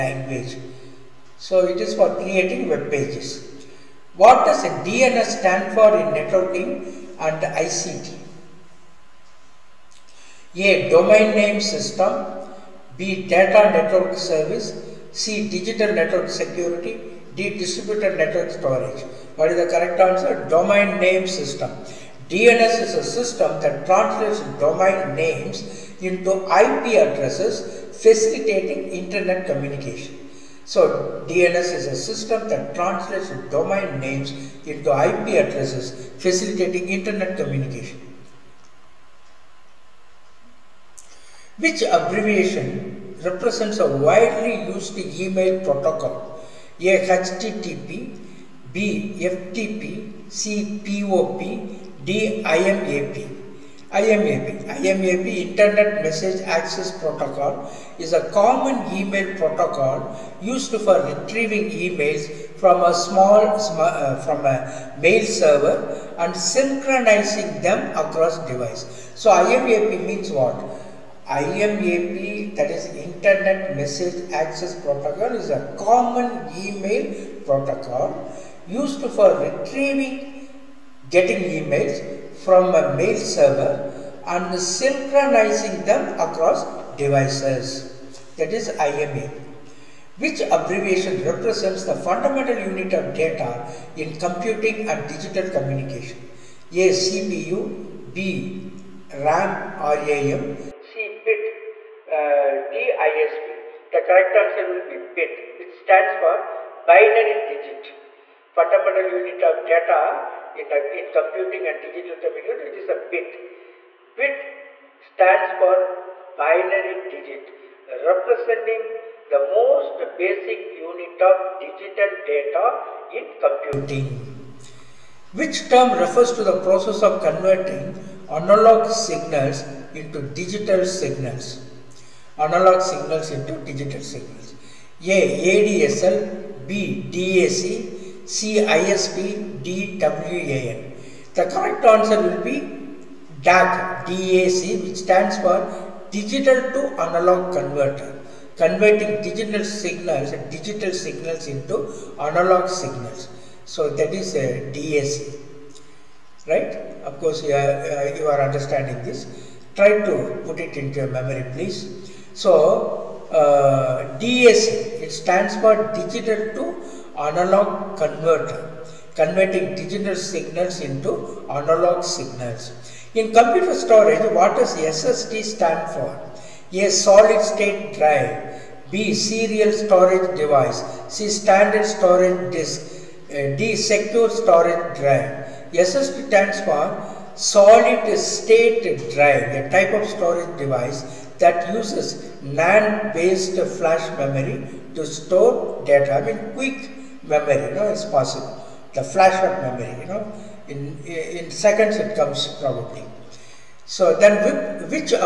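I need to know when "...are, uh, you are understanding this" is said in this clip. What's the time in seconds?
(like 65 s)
157 s.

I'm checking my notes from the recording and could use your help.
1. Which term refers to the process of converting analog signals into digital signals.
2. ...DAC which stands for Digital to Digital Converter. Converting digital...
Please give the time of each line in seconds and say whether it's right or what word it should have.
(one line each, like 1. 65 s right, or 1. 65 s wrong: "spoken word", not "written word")
1. 125 s right
2. 144 s wrong: "Analog", not "Digital".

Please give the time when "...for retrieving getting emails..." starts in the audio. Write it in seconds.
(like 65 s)
79 s.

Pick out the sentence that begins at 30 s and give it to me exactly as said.
So DNS is a system that translates domain names into IP addresses facilitating internet communication.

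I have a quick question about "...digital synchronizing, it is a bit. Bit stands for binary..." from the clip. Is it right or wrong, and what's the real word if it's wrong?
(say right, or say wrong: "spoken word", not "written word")
wrong: "computing", not "synchronizing".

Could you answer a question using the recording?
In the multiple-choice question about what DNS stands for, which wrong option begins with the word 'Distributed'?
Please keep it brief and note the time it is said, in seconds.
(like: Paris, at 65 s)
Distributed network storage, at 17 s.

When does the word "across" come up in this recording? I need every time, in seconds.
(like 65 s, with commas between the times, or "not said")
67 s, 86 s.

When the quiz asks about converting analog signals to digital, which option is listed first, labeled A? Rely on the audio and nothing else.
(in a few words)
ADSL.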